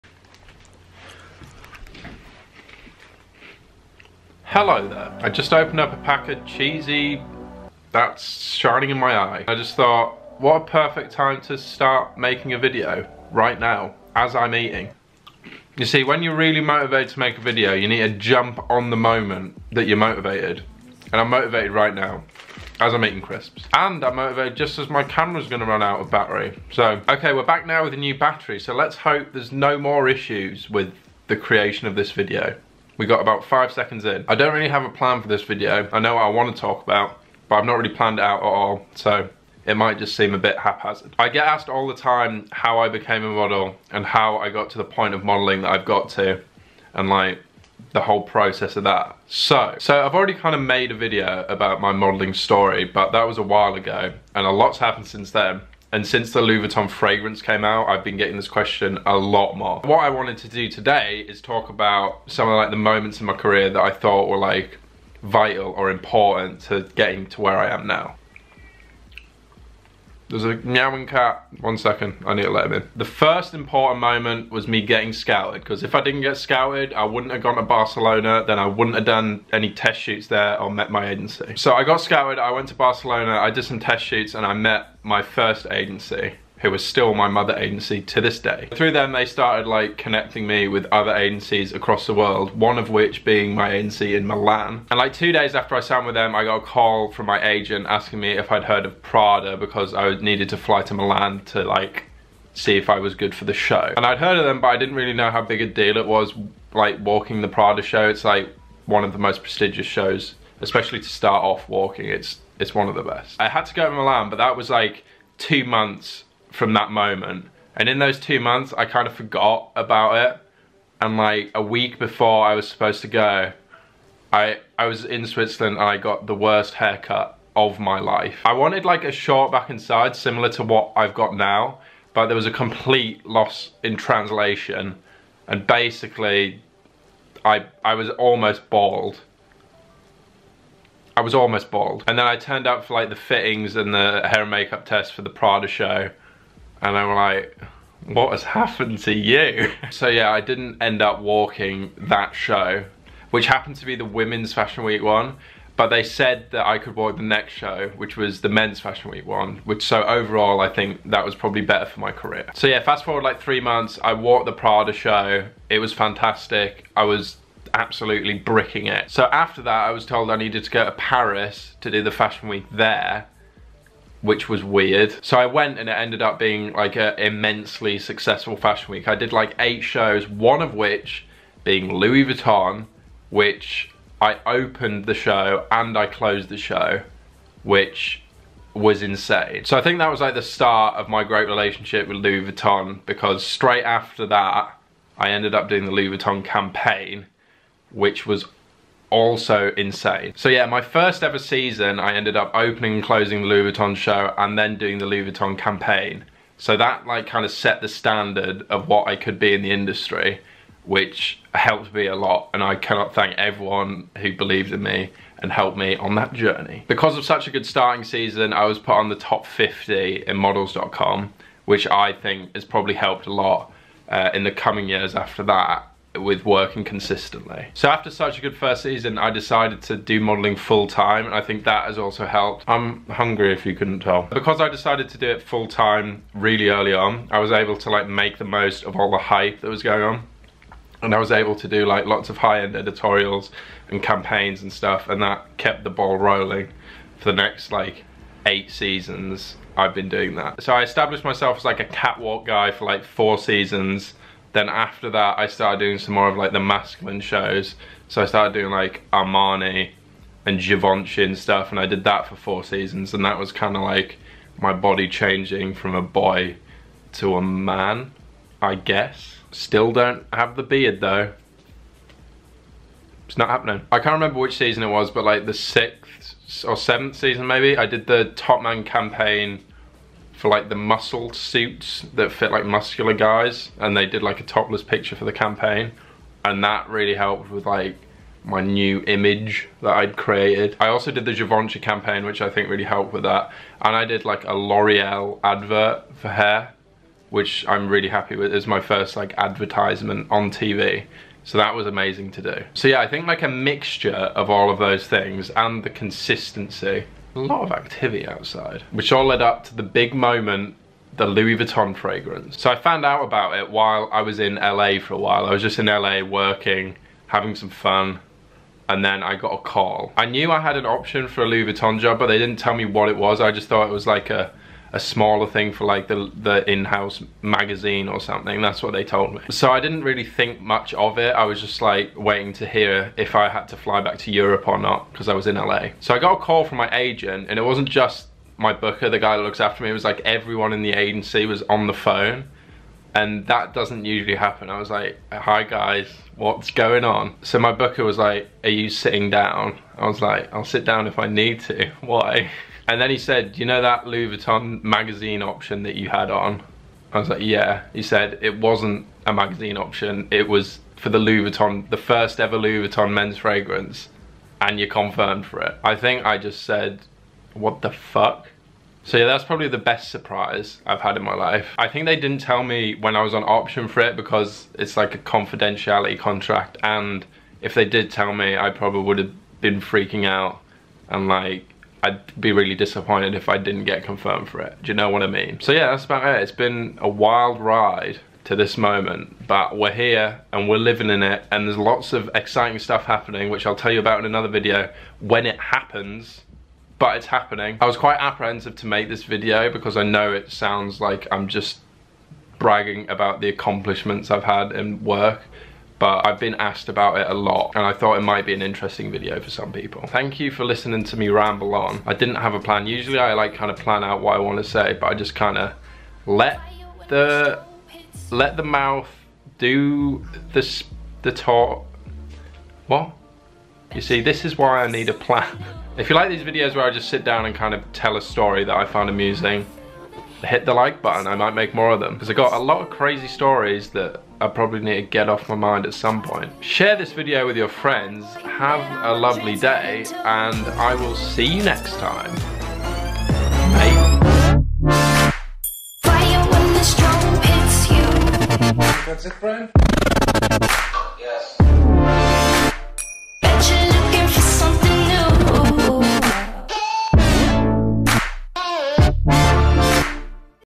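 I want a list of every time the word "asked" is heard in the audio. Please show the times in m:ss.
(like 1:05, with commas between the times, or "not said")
0:41, 6:46.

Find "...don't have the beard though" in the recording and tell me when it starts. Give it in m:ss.
4:29.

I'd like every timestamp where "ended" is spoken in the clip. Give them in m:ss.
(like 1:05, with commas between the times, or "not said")
2:55, 3:15, 3:22.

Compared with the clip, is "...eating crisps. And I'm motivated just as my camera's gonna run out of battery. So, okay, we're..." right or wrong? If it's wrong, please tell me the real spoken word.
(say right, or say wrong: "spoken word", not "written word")
right.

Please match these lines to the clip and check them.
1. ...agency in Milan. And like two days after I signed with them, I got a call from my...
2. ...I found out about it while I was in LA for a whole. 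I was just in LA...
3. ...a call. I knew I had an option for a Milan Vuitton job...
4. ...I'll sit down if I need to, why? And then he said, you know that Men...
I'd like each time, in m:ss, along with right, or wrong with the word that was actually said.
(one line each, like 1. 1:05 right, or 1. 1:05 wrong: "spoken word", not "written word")
1. 1:33 right
2. 5:12 wrong: "while", not "whole"
3. 5:19 wrong: "Louis", not "Milan"
4. 5:50 wrong: "Louis", not "Men".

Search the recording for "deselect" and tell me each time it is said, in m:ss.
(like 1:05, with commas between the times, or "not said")
not said.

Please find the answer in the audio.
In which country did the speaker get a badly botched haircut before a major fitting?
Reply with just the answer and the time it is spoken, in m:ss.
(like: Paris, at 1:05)
Switzerland, at 2:05.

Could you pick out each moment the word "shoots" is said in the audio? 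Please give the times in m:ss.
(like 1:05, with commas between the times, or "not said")
1:19, 1:24.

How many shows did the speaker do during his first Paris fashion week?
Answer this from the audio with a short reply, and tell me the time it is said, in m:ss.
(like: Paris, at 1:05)
8, at 2:59.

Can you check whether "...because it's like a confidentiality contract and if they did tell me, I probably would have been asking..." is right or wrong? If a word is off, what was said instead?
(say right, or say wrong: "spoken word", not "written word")
wrong: "freaking", not "asking".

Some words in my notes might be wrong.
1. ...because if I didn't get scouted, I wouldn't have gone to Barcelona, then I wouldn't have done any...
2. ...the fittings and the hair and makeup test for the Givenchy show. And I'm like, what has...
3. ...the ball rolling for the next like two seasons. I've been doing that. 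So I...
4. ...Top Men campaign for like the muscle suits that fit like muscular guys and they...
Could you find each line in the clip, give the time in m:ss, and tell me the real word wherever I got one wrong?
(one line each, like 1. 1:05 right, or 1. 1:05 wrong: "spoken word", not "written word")
1. 1:15 right
2. 2:23 wrong: "Prada", not "Givenchy"
3. 4:05 wrong: "eight", not "two"
4. 4:38 wrong: "Man", not "Men".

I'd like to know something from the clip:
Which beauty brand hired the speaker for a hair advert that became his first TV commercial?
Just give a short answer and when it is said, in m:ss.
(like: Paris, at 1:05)
L'Oreal, at 4:54.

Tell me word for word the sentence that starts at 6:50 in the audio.
Thank you for listening to me ramble on.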